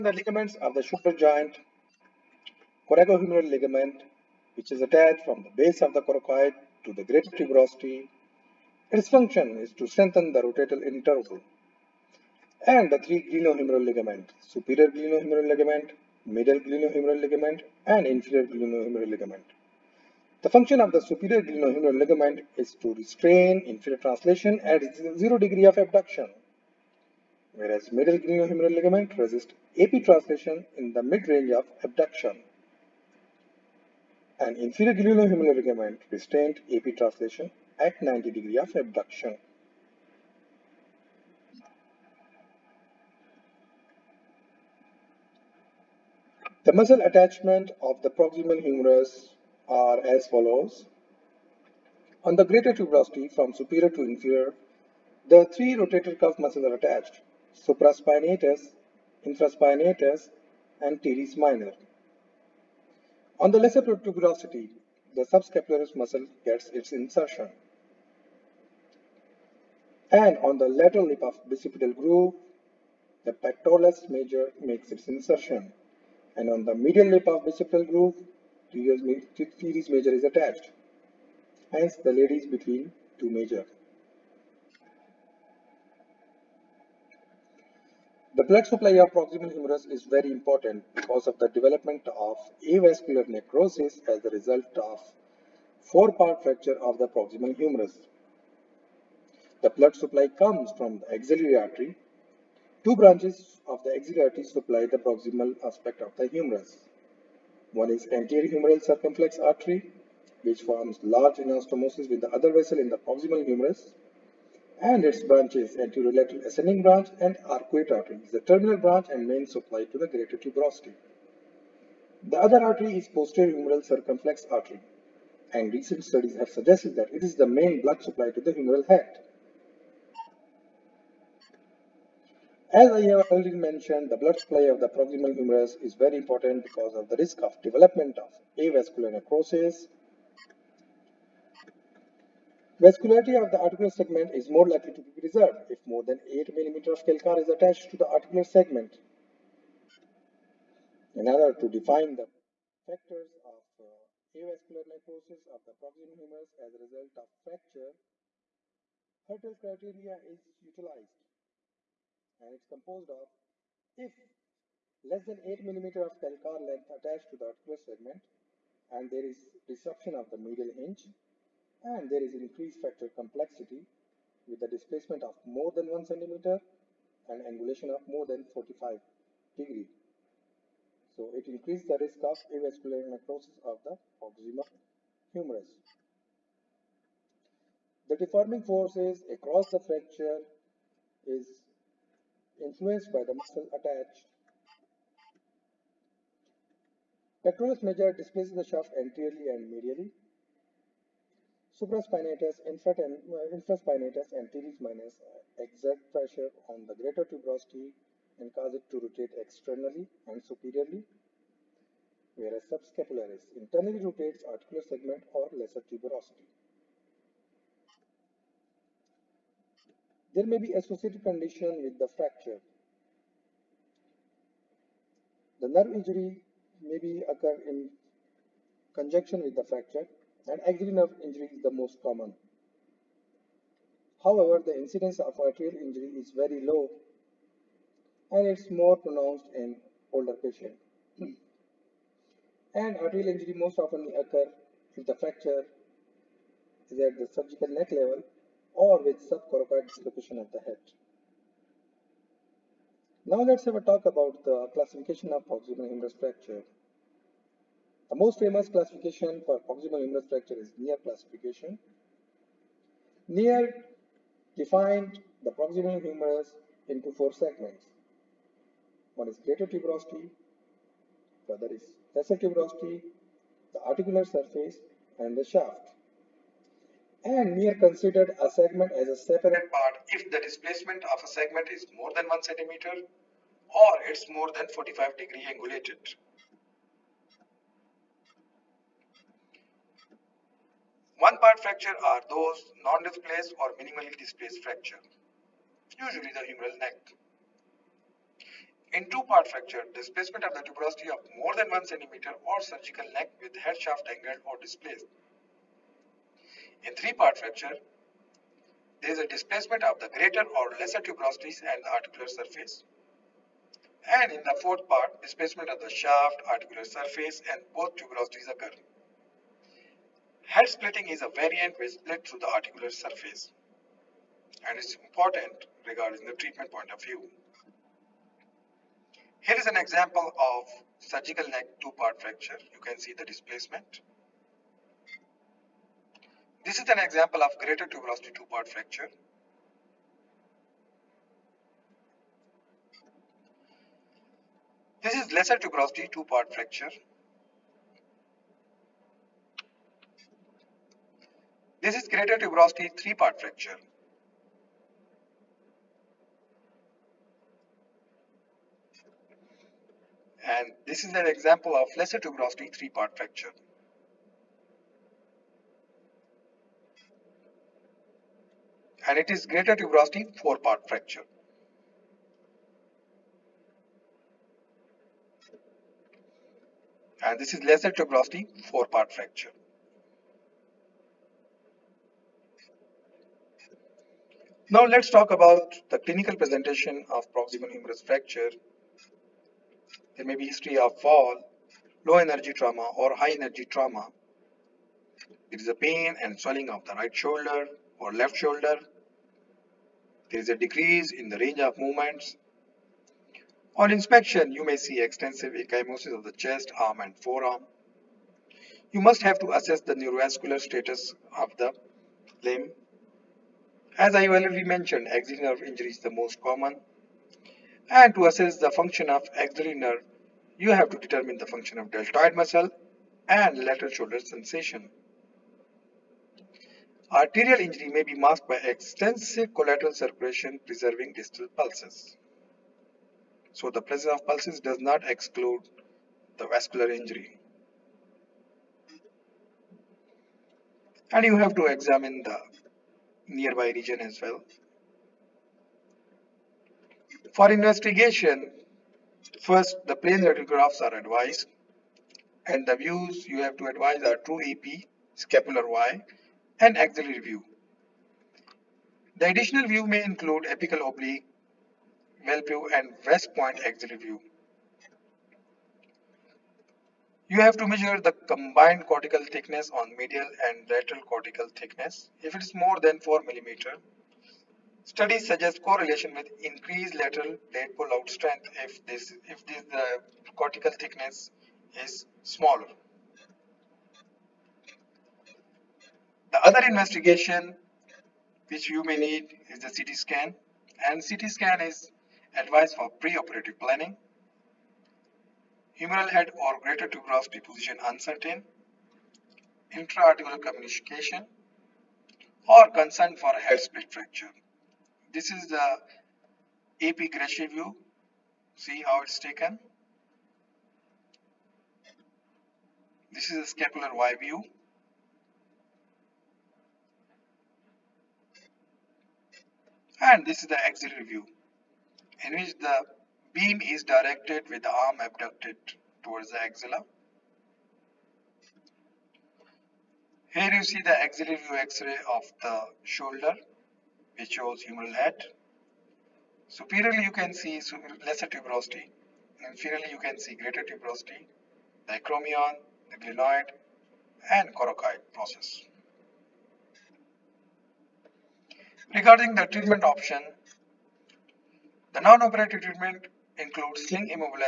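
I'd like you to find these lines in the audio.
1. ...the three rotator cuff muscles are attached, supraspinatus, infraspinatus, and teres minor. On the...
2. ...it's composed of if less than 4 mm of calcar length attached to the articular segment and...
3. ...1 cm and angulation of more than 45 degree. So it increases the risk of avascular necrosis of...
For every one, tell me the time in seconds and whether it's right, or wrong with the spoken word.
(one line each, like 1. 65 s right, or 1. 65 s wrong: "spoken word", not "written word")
1. 55 s right
2. 162 s wrong: "8", not "4"
3. 175 s right.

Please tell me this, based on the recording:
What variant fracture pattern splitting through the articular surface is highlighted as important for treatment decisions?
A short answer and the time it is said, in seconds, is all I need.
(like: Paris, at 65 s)
Head splitting, at 320 s.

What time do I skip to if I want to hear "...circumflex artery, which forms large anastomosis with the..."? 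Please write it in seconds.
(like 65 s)
108 s.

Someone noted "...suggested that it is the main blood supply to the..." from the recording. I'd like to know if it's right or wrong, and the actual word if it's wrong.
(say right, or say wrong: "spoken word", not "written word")
right.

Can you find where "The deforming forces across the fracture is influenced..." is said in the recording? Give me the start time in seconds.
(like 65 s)
188 s.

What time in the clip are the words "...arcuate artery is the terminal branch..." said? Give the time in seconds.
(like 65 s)
117 s.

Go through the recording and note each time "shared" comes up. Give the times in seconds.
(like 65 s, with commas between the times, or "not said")
not said.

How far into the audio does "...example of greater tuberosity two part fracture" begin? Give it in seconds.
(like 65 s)
336 s.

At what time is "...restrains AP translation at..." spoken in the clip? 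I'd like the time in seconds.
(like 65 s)
36 s.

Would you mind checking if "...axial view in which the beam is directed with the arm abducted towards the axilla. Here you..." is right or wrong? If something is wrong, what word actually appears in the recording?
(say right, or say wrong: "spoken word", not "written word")
right.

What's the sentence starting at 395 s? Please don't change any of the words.
It is a pain and swelling of the right shoulder or left shoulder there is a decrease in the range of movements.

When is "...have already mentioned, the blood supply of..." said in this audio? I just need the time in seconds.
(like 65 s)
133 s.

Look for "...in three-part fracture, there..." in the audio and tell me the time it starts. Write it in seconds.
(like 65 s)
306 s.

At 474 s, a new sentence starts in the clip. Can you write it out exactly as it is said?
Studies suggest correlation with increased lateral blade pull-out strength if this if this the cortical thickness is smaller.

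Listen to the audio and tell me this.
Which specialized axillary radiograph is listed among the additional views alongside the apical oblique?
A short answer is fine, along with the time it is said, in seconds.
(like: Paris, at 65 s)
West Point axillary view, at 463 s.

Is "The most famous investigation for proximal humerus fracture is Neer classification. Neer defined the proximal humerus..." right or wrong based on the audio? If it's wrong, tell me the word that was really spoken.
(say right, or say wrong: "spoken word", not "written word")
wrong: "classification", not "investigation".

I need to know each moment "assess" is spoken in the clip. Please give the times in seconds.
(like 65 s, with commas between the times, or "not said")
409 s, 418 s.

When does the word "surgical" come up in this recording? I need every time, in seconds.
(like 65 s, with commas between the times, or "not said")
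247 s, 302 s, 330 s.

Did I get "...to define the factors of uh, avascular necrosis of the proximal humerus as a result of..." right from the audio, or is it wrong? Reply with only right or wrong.
right.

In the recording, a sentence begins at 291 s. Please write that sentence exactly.
One part fracture are those non-displaced or minimally displaced fracture, usually the humeral neck.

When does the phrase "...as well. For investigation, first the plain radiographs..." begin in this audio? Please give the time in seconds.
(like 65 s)
443 s.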